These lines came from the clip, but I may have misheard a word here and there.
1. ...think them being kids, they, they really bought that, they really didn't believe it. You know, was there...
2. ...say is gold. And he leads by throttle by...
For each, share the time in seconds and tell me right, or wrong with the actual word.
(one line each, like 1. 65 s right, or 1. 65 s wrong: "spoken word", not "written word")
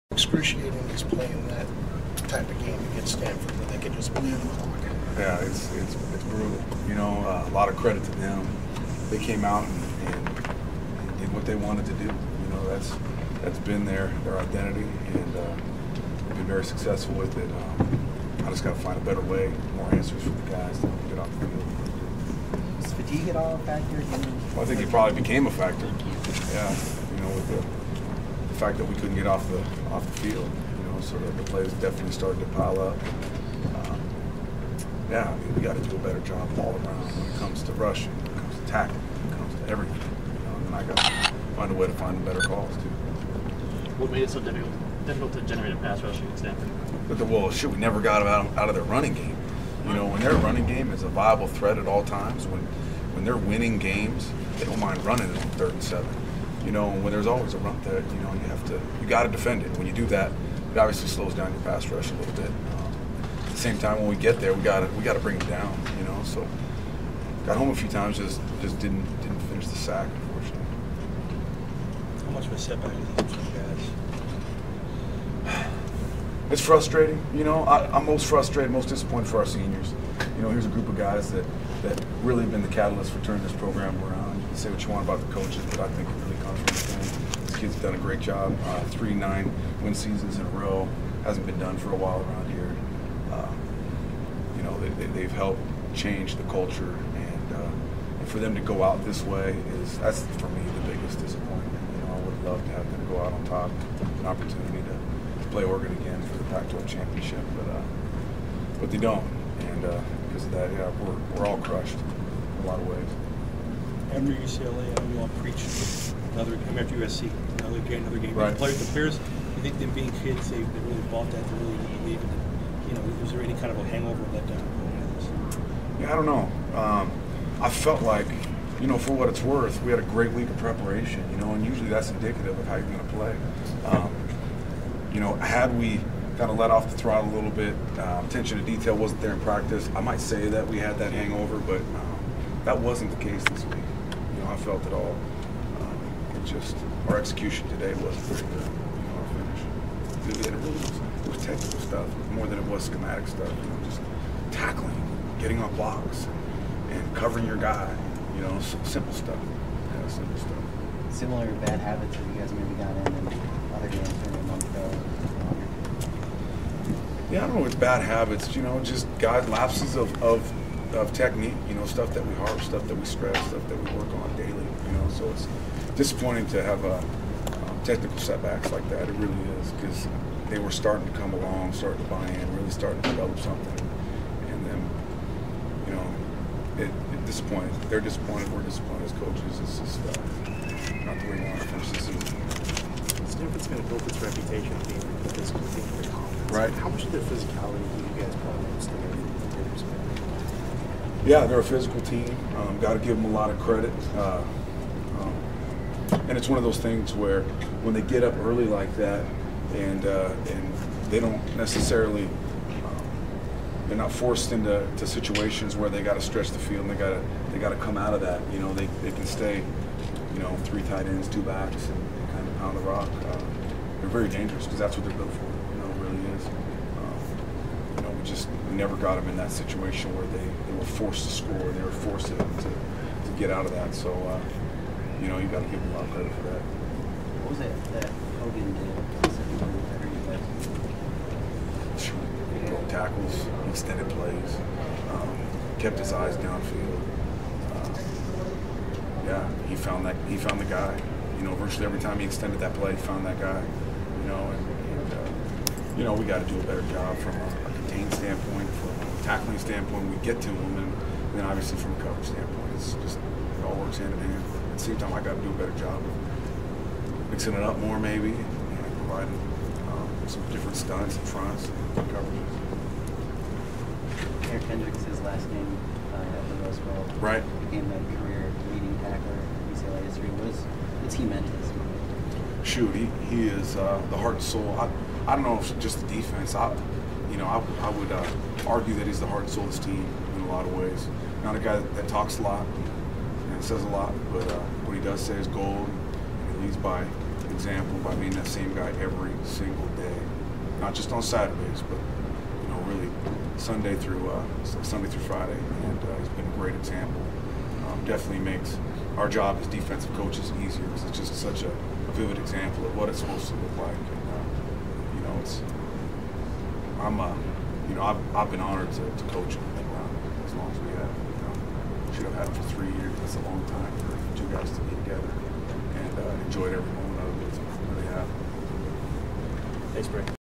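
1. 119 s right
2. 295 s wrong: "example", not "throttle".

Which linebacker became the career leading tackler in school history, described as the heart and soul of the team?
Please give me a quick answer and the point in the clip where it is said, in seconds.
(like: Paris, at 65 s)
Eric Kendricks, at 274 s.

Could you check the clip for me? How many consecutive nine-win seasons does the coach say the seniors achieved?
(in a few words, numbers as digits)
3.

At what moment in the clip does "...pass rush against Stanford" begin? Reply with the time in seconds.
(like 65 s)
45 s.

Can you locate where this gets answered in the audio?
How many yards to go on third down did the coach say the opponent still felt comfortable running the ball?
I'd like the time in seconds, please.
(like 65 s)
55 s.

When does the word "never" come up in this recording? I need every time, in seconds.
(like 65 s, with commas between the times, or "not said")
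47 s, 228 s.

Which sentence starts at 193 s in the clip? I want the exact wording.
Stanford's going to build its reputation being a physical right?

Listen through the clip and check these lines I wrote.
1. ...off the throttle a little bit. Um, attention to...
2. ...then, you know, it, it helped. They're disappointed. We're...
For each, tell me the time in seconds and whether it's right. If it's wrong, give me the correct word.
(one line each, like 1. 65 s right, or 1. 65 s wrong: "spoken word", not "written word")
1. 136 s right
2. 184 s wrong: "disappointed", not "helped".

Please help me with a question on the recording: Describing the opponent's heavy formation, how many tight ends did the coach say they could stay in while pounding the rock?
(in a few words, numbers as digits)
3.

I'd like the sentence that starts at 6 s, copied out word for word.
You know, uh, a lot of credit to them.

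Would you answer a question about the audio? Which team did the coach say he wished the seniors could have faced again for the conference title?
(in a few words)
Oregon.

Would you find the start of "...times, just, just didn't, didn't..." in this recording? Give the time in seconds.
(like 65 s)
67 s.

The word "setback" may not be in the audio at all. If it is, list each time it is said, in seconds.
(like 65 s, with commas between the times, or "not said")
72 s, 178 s.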